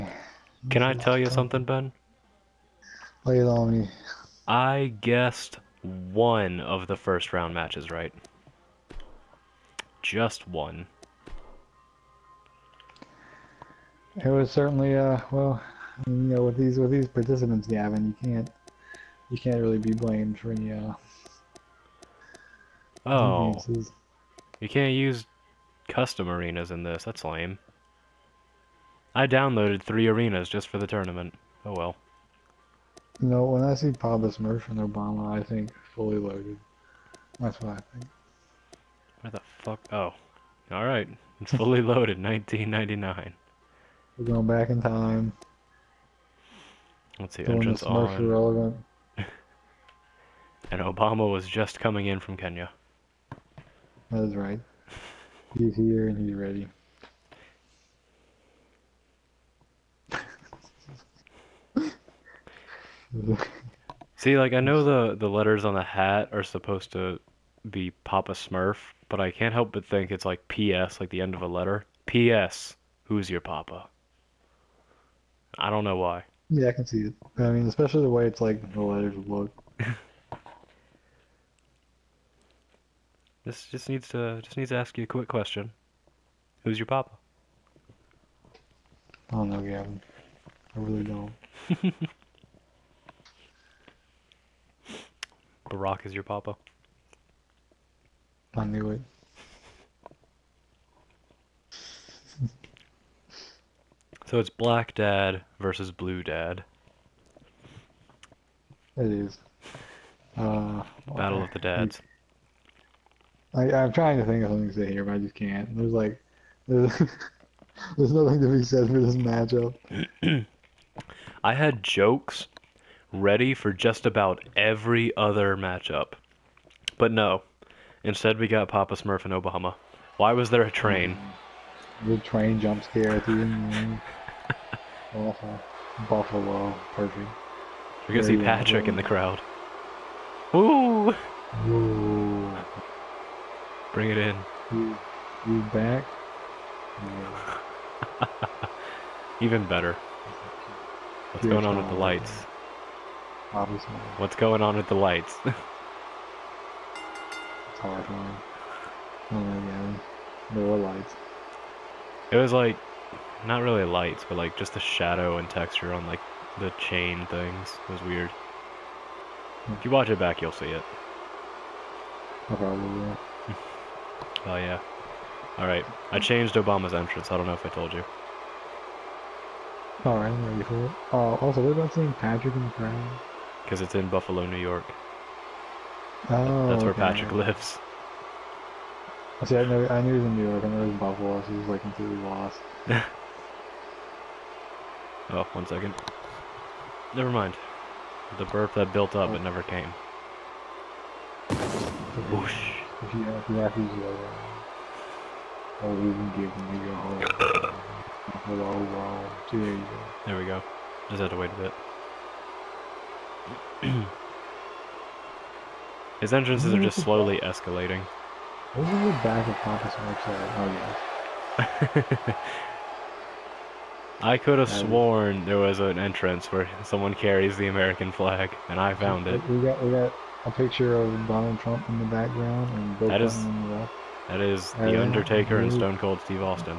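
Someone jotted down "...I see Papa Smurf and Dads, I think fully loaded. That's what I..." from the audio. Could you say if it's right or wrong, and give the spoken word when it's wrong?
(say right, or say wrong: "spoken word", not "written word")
wrong: "Obama", not "Dads".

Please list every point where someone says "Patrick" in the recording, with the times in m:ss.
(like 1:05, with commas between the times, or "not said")
2:18, 3:02, 3:07.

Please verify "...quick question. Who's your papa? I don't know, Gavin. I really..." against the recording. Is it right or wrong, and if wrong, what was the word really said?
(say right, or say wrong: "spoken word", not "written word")
right.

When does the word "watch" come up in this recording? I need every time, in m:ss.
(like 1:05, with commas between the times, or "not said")
2:49.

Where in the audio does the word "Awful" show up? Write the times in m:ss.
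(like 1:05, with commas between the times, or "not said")
2:15.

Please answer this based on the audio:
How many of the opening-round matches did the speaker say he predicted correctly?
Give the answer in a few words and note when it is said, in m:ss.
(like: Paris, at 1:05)
1, at 0:10.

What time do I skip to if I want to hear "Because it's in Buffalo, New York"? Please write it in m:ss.
3:03.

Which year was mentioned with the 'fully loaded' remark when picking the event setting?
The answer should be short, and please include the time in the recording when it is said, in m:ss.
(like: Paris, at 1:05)
1999, at 0:42.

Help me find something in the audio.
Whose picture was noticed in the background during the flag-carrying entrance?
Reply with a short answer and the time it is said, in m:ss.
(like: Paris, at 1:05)
Donald Trump, at 3:51.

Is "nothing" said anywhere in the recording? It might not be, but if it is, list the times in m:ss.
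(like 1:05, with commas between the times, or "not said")
1:58.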